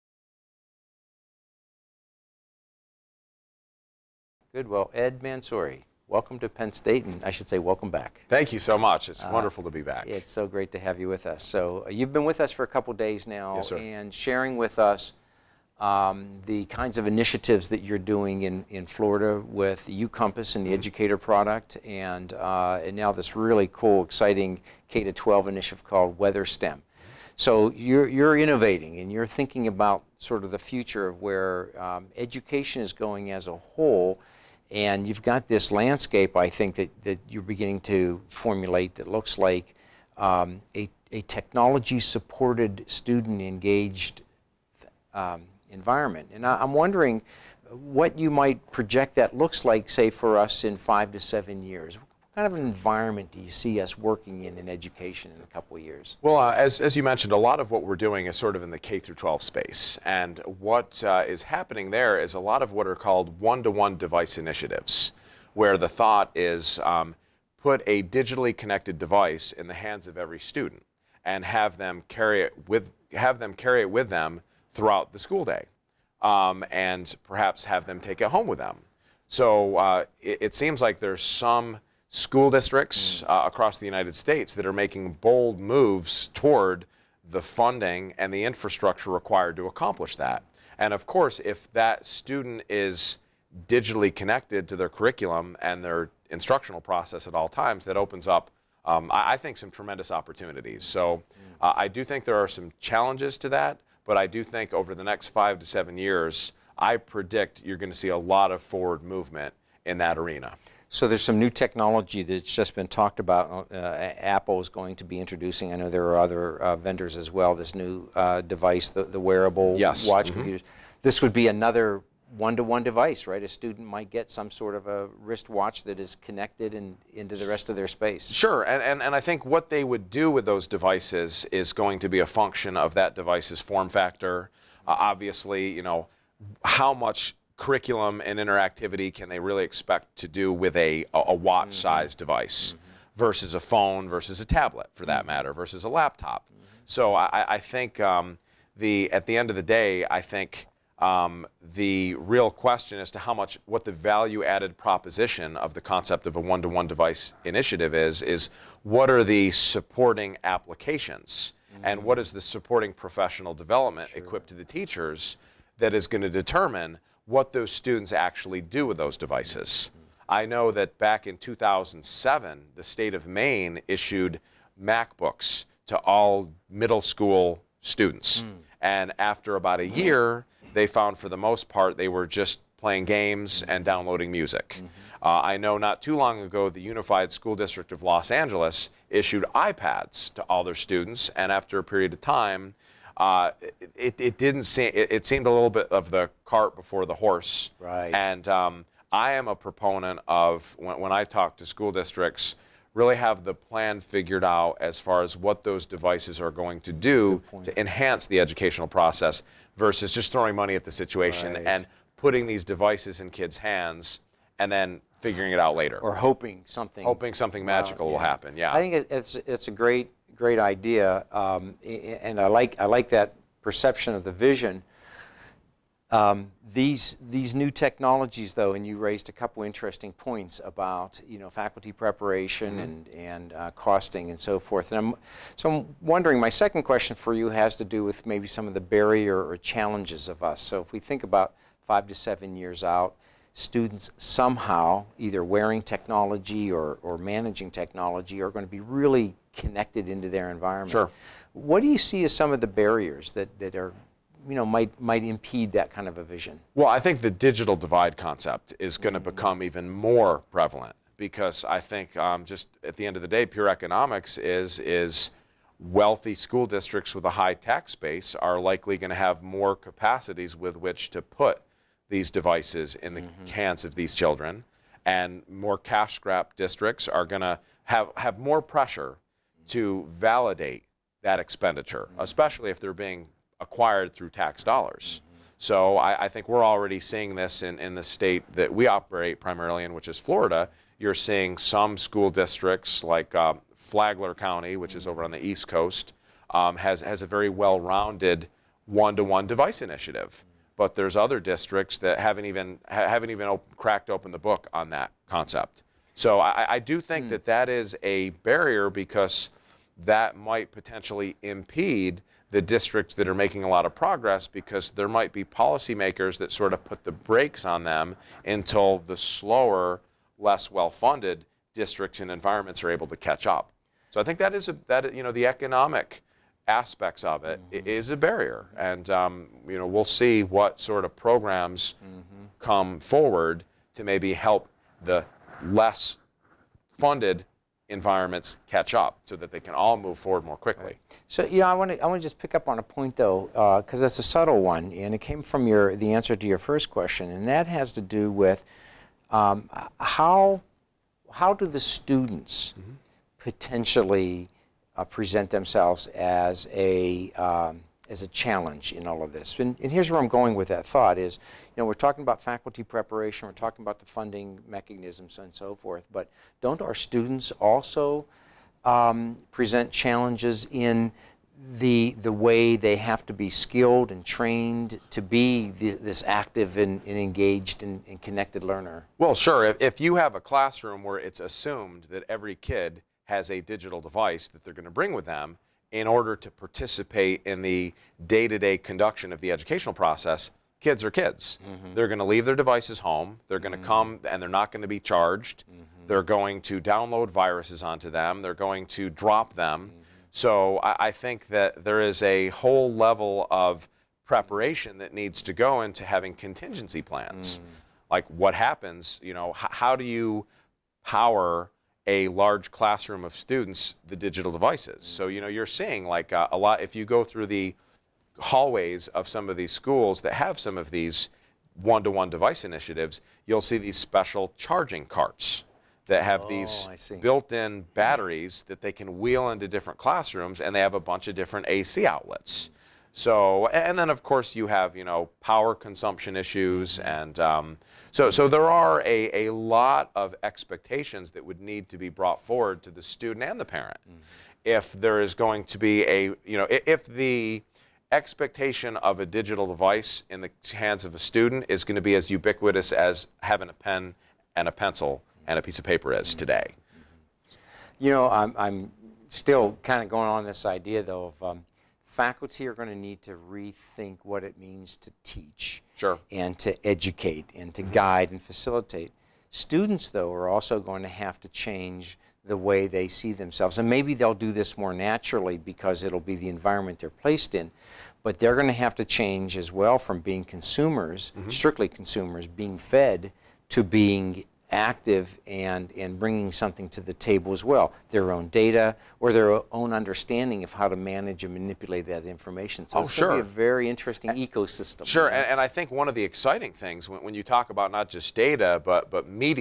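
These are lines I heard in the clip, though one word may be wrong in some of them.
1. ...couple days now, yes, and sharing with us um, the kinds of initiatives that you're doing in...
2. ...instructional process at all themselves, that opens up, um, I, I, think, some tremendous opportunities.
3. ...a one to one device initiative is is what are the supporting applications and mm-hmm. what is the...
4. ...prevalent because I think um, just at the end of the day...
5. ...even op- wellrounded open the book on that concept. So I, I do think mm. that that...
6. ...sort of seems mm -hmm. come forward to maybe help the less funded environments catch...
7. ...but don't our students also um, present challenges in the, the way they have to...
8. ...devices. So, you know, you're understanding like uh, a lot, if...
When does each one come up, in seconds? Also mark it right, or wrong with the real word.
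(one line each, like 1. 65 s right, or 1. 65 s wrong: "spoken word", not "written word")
1. 12 s right
2. 96 s wrong: "times", not "themselves"
3. 156 s right
4. 260 s right
5. 303 s wrong: "cracked", not "wellrounded"
6. 330 s wrong: "programs", not "seems"
7. 366 s right
8. 414 s wrong: "seeing", not "understanding".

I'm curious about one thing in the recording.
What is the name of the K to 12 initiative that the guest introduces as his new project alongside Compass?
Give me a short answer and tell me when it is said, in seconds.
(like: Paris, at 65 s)
Weather STEM, at 26 s.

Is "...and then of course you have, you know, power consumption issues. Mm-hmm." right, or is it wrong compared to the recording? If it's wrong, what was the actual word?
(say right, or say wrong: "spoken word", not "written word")
right.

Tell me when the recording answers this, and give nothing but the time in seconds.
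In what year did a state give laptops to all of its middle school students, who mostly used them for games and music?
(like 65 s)
171 s.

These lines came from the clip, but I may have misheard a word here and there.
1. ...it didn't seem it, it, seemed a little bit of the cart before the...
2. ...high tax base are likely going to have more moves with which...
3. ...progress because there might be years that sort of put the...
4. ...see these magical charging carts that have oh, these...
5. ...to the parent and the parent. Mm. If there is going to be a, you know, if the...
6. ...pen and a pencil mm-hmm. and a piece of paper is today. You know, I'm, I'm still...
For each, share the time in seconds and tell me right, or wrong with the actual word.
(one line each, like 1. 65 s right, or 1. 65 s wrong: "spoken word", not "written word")
1. 194 s right
2. 267 s wrong: "capacities", not "moves"
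3. 313 s wrong: "policymakers", not "years"
4. 423 s wrong: "special", not "magical"
5. 442 s wrong: "student", not "parent"
6. 453 s right.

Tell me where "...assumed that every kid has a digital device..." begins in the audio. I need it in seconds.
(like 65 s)
381 s.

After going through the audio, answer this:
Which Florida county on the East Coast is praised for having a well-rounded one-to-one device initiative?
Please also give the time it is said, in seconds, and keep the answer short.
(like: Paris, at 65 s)
Flagler County, at 293 s.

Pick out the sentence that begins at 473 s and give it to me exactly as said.
And maybe they'll do this more naturally because it'll be the environment they're placed in.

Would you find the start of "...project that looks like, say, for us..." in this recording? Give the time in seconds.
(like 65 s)
48 s.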